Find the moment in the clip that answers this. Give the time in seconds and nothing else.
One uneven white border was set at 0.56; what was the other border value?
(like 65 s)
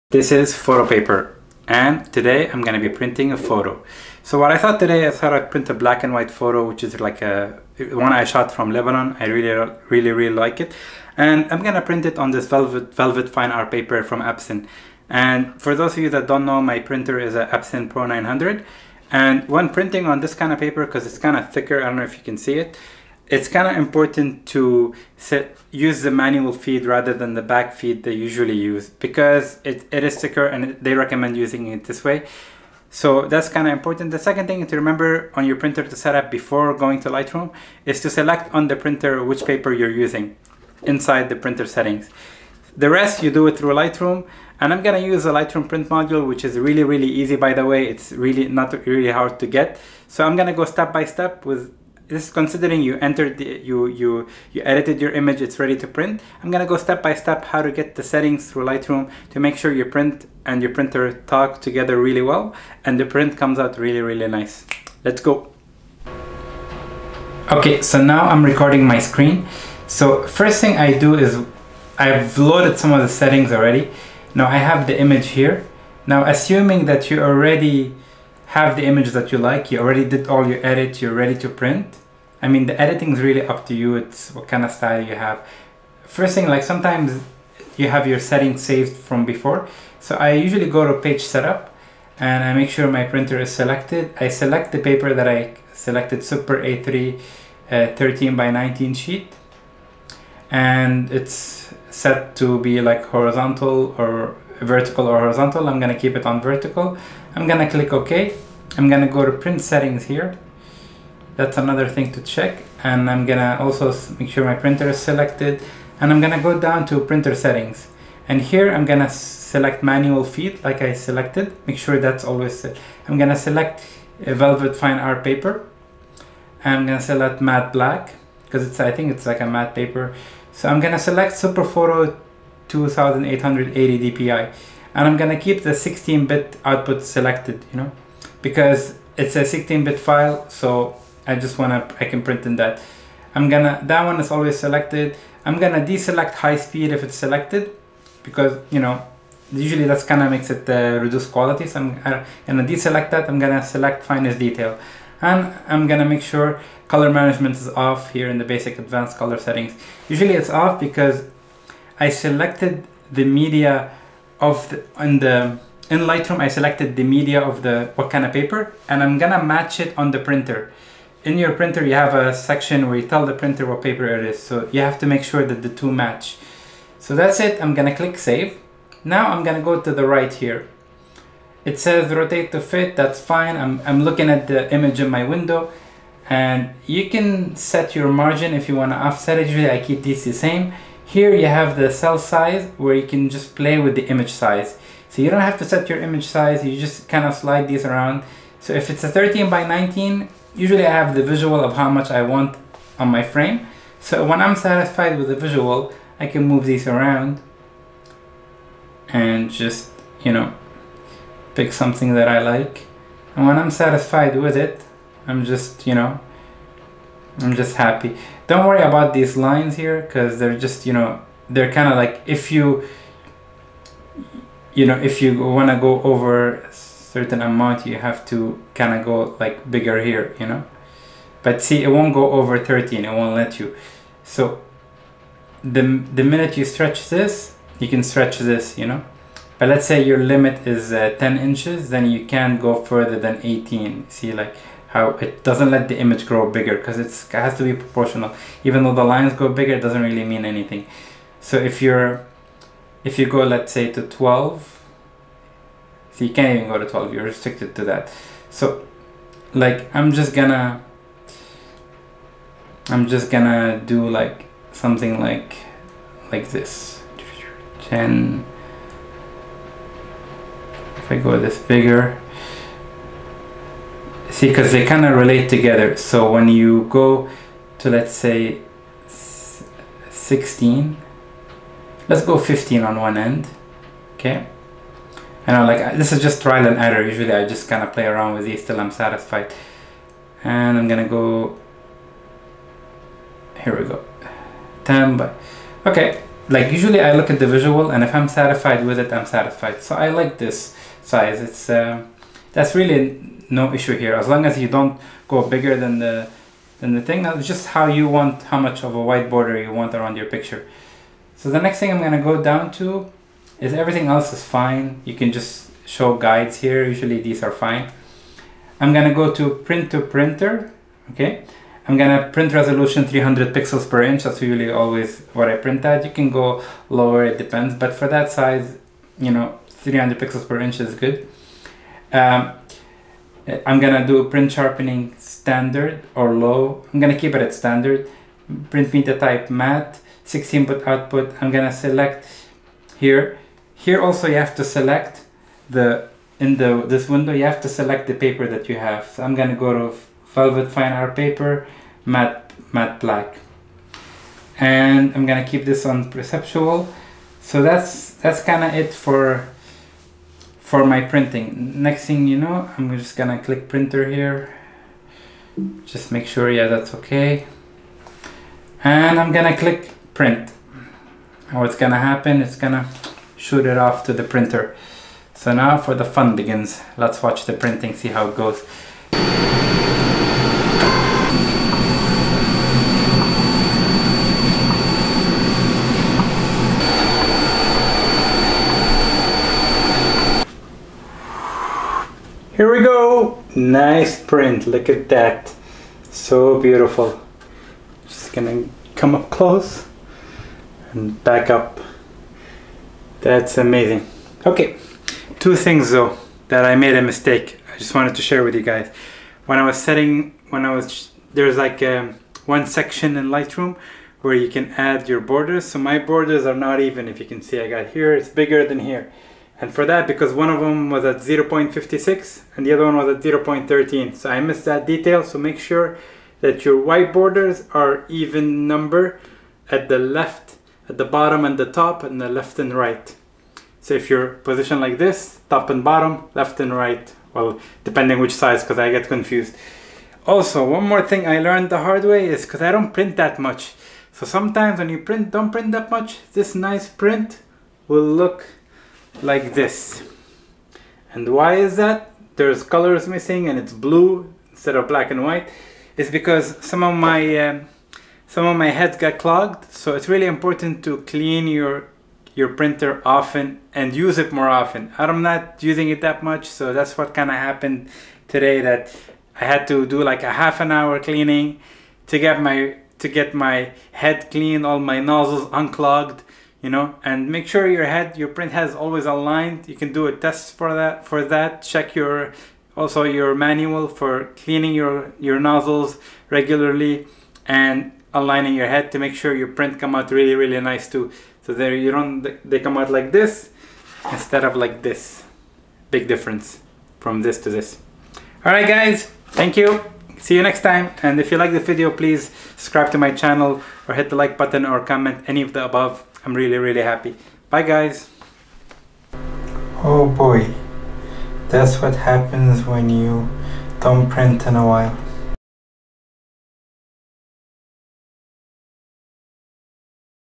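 423 s.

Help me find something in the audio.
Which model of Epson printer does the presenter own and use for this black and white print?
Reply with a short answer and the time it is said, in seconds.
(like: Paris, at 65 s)
Epson Pro 900, at 17 s.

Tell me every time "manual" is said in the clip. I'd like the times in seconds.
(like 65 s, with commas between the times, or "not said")
26 s, 119 s, 483 s.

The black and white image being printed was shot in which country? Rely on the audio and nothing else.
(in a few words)
Lebanon.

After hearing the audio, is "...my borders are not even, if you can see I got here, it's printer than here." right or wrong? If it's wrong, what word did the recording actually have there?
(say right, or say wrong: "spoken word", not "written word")
wrong: "bigger", not "printer".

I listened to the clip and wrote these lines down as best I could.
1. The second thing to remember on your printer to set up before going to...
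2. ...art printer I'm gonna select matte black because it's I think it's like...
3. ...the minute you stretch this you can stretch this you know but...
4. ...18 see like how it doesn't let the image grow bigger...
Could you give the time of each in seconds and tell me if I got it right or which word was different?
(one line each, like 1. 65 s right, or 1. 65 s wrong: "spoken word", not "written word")
1. 34 s right
2. 124 s wrong: "paper", not "printer"
3. 236 s right
4. 243 s right.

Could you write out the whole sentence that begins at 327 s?
But for that size, you know, 300 pixels per inch is good.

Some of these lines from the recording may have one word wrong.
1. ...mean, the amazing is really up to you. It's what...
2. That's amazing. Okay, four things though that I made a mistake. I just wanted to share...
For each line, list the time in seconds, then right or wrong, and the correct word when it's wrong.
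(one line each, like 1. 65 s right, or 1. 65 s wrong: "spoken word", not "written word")
1. 82 s wrong: "editing", not "amazing"
2. 403 s wrong: "two", not "four".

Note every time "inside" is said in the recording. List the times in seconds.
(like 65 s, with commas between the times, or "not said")
40 s.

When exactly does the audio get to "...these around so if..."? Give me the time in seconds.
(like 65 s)
197 s.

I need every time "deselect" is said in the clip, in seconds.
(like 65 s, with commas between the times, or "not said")
145 s, 152 s.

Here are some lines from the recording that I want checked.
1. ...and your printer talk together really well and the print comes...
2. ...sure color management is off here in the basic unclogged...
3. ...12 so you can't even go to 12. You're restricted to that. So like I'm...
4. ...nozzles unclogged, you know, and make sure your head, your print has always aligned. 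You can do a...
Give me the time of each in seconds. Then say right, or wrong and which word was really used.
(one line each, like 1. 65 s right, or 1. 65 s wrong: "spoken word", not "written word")
1. 60 s right
2. 156 s wrong: "advanced", not "unclogged"
3. 254 s right
4. 475 s right.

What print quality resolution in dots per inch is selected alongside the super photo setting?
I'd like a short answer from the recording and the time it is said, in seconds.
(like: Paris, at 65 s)
2880 dpi, at 132 s.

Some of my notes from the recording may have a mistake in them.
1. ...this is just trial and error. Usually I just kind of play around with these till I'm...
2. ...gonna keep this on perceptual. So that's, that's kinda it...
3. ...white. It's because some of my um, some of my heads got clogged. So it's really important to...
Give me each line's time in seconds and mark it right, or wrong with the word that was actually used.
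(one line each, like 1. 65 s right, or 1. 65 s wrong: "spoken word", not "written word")
1. 285 s right
2. 355 s right
3. 455 s right.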